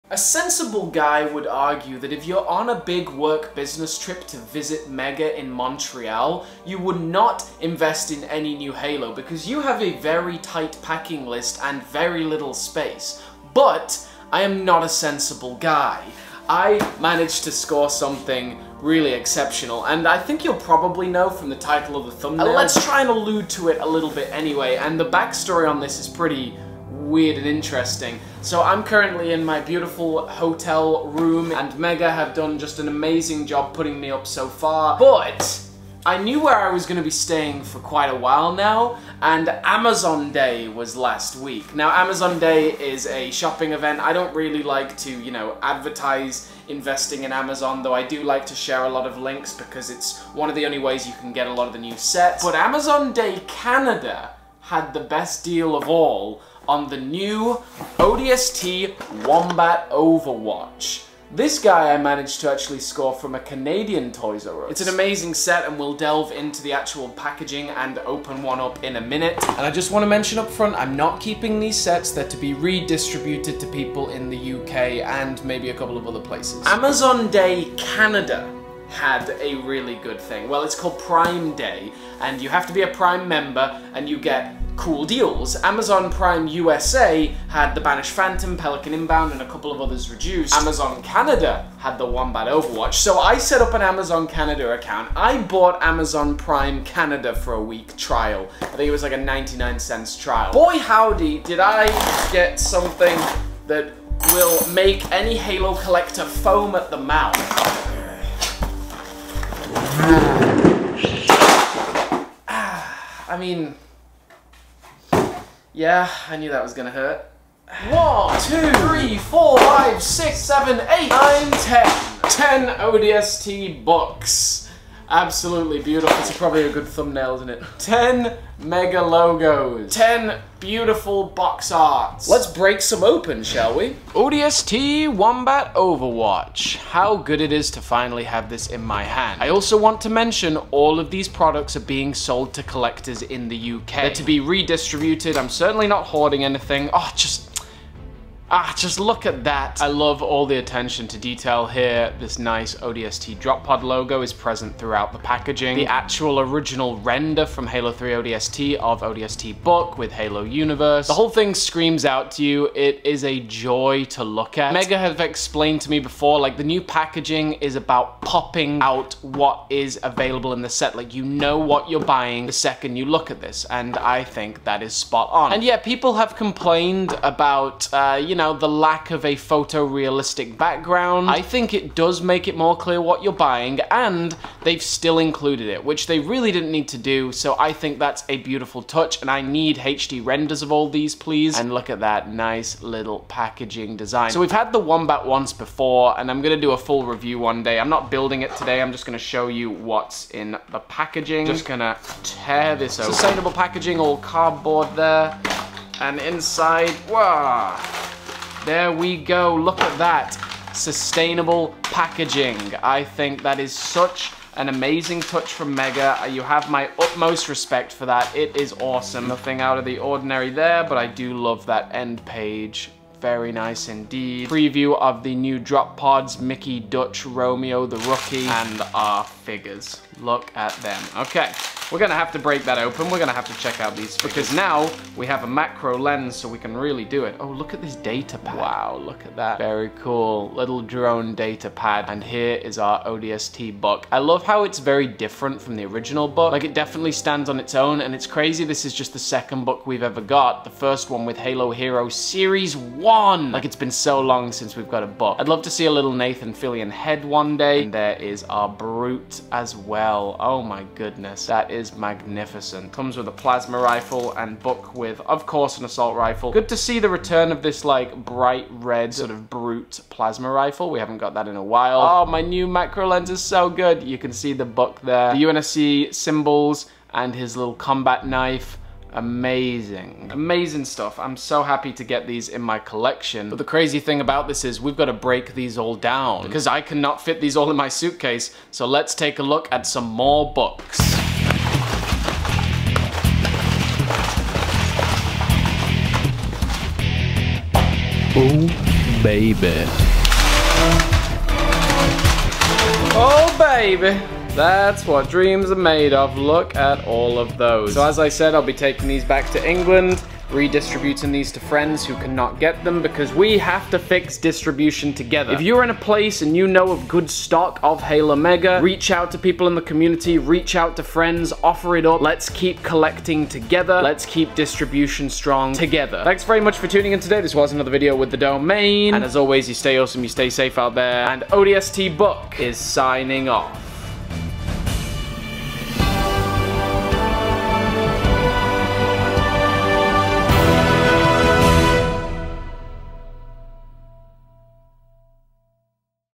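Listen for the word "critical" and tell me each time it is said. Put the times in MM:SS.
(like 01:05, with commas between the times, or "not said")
not said.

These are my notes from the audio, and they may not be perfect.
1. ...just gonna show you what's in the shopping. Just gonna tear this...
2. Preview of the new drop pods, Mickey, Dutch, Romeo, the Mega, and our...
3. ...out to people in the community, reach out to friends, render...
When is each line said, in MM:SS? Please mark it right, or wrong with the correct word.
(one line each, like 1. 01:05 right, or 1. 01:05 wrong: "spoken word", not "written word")
1. 03:18 wrong: "packaging", not "shopping"
2. 03:44 wrong: "Rookie", not "Mega"
3. 05:19 wrong: "offer", not "render".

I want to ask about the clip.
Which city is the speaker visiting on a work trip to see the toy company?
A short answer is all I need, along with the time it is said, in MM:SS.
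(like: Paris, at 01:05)
Montreal, at 00:05.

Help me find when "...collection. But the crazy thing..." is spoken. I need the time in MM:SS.
04:42.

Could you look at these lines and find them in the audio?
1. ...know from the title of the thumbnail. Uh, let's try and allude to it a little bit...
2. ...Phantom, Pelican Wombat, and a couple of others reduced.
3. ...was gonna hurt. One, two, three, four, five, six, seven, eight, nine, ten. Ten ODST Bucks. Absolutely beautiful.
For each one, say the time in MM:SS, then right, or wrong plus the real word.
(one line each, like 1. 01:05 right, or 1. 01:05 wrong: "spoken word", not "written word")
1. 00:21 right
2. 01:28 wrong: "Inbound", not "Wombat"
3. 01:56 right.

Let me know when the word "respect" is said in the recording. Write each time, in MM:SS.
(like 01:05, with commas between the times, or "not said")
03:37.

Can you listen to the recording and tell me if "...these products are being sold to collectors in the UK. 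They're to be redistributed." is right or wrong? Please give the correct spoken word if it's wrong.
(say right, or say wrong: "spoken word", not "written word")
right.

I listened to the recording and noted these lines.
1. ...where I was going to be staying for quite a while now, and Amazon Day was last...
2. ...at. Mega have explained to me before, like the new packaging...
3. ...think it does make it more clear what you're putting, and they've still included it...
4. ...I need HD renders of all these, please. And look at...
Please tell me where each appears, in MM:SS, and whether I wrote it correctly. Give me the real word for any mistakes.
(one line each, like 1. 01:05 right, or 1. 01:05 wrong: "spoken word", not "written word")
1. 00:36 right
2. 02:44 right
3. 03:01 wrong: "buying", not "putting"
4. 03:09 right.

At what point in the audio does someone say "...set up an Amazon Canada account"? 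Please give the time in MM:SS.
01:33.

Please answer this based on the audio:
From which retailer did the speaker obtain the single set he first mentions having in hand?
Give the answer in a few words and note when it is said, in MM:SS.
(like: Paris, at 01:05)
Toys R Us, at 01:04.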